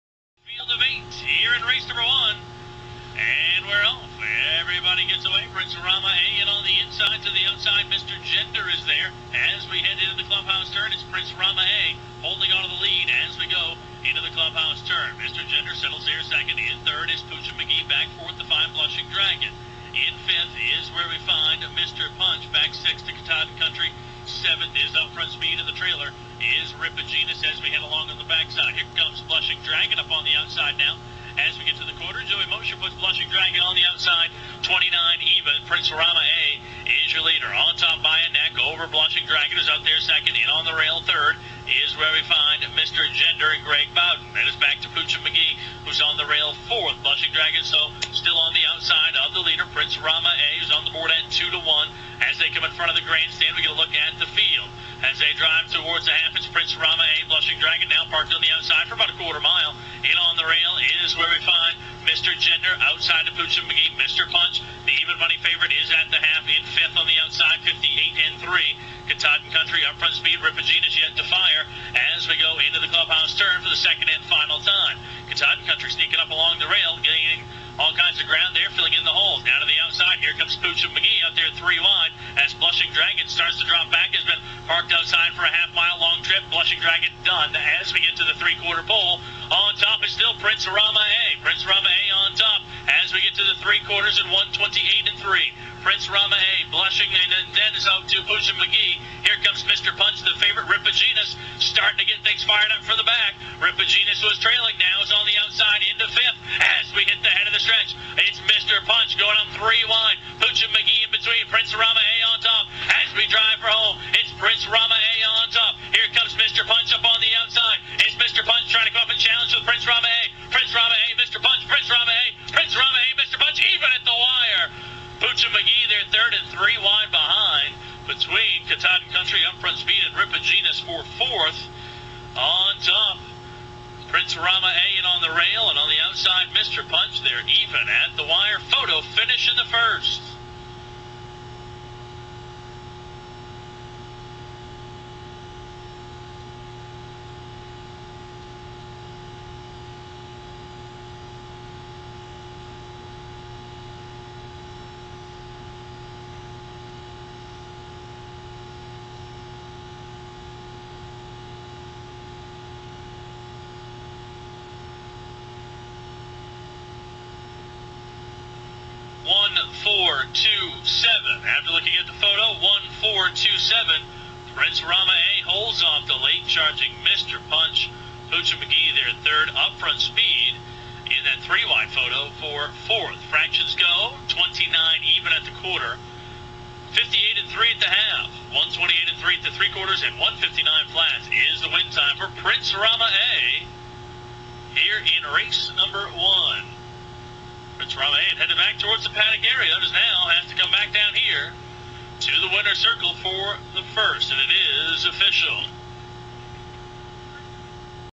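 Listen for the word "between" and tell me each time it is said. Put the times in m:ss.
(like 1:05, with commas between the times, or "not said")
1:51, 2:08.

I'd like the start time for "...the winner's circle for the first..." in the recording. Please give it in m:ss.
3:22.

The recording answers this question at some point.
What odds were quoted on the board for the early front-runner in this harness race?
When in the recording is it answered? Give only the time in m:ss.
0:51.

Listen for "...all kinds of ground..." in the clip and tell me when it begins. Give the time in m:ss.
1:17.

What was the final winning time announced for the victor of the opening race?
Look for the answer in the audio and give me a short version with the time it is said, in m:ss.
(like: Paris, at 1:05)
1:59 flat, at 3:10.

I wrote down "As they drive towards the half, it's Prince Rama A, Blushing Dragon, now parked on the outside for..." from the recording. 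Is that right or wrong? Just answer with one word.
right.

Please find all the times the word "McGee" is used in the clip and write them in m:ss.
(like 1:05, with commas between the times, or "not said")
0:17, 0:45, 1:03, 1:20, 1:38, 1:50, 2:58.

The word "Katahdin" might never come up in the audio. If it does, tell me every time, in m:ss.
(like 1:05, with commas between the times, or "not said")
0:23, 1:09, 1:15, 2:08.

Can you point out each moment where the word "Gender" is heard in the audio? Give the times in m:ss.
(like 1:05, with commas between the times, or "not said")
0:08, 0:15, 0:43, 1:02.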